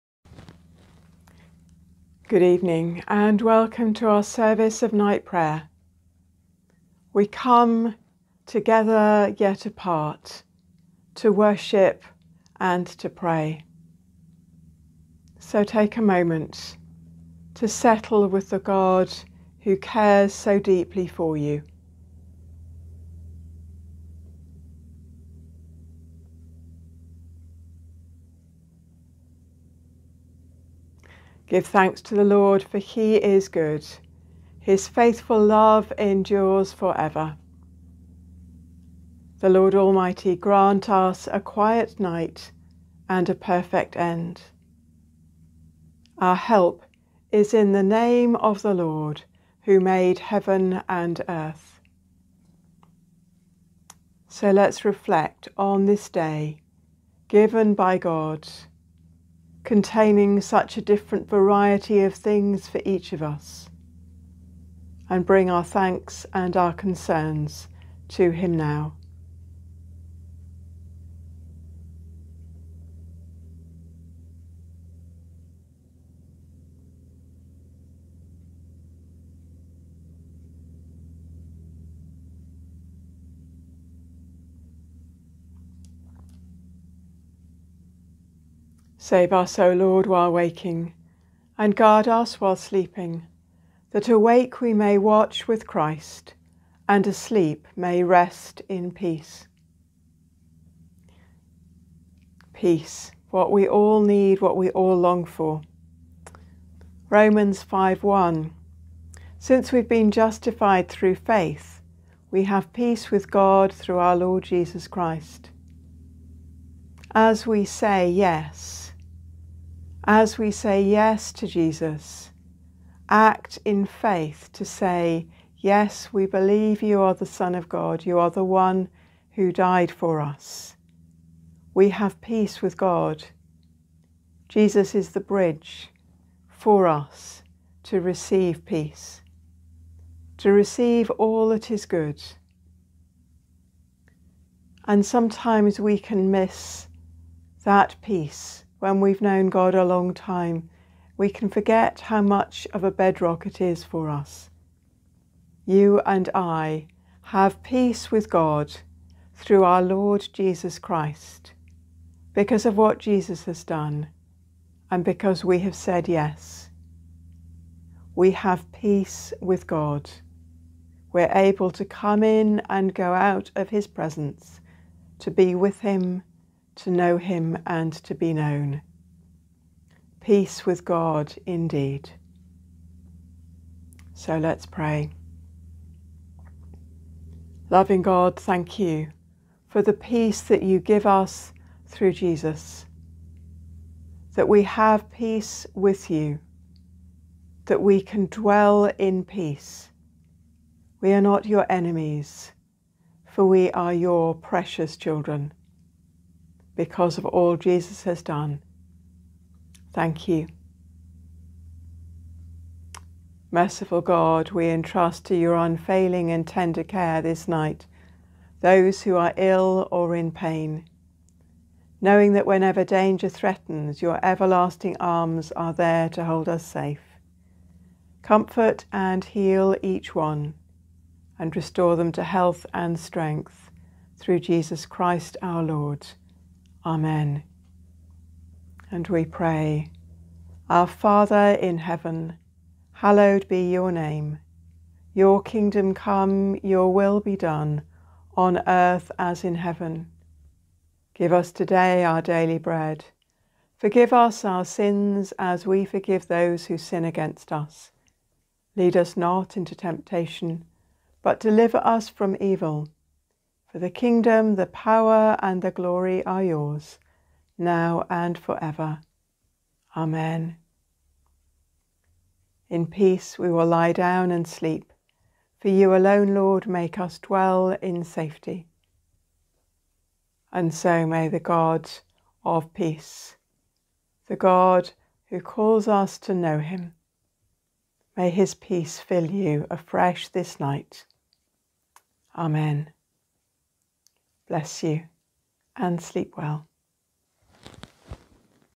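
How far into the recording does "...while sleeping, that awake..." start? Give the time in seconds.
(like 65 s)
92 s.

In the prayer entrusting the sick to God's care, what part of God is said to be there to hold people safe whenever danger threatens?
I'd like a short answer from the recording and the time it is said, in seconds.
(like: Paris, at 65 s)
Everlasting arms, at 224 s.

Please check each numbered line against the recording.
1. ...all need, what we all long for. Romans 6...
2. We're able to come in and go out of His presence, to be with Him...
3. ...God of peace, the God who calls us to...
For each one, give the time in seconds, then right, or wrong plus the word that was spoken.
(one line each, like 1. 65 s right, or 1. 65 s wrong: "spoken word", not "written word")
1. 103 s wrong: "5", not "6"
2. 171 s right
3. 281 s right.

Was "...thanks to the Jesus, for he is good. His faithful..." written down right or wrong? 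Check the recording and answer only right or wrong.
wrong.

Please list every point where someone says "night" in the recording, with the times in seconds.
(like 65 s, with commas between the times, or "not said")
4 s, 41 s, 217 s, 290 s.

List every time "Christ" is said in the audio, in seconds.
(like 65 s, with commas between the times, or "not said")
95 s, 114 s, 160 s, 234 s.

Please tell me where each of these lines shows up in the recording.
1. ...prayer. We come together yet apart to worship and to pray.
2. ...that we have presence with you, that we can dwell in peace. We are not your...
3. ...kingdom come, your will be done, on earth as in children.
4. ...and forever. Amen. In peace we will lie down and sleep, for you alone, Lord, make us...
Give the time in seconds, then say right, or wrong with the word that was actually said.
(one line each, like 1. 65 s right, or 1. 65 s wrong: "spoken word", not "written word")
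1. 5 s right
2. 194 s wrong: "peace", not "presence"
3. 245 s wrong: "heaven", not "children"
4. 268 s right.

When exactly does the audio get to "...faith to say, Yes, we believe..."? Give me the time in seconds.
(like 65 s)
123 s.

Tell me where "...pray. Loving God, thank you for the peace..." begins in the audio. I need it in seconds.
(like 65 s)
184 s.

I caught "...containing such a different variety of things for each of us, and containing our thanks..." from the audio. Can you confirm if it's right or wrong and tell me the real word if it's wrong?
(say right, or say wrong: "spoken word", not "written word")
wrong: "bring", not "containing".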